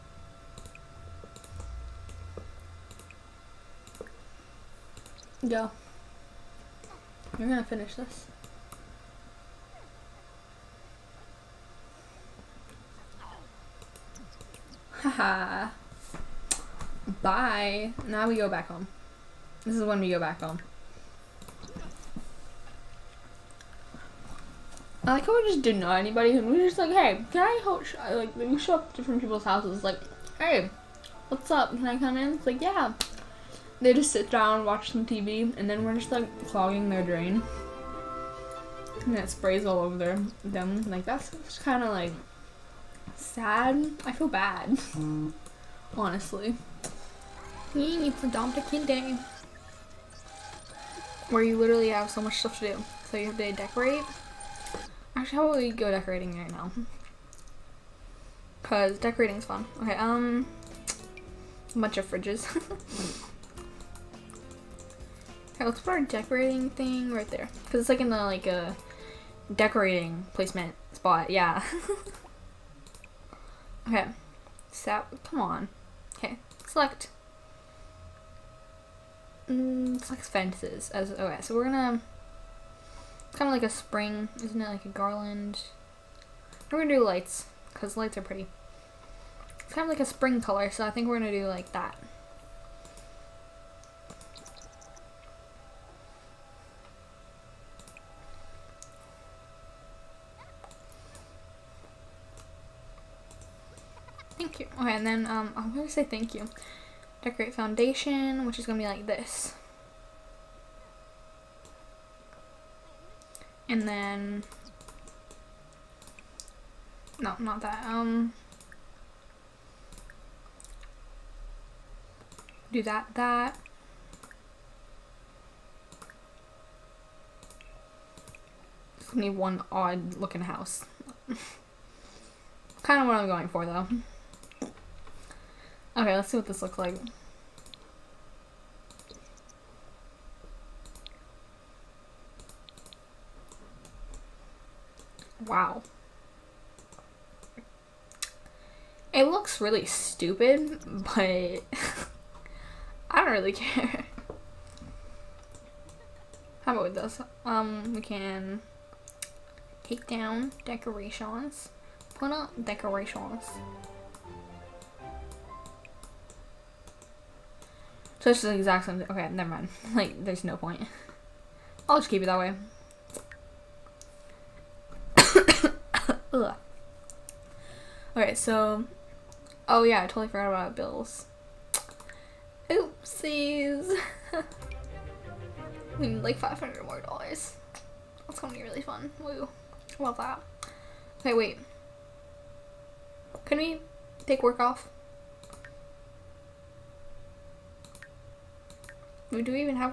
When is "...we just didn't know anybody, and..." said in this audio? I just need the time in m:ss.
0:25.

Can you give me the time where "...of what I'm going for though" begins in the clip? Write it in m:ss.
2:13.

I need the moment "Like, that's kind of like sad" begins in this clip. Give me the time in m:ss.
0:40.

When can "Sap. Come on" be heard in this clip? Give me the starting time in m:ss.
1:14.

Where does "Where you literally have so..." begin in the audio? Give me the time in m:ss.
0:51.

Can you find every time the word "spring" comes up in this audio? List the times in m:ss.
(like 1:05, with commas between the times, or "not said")
1:23, 1:30.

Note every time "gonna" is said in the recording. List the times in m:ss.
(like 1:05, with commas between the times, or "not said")
0:07, 1:21, 1:26, 1:31, 2:09, 3:08.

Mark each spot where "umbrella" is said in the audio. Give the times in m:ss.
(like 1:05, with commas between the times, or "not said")
not said.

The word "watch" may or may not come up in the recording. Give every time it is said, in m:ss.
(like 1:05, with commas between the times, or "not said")
0:34.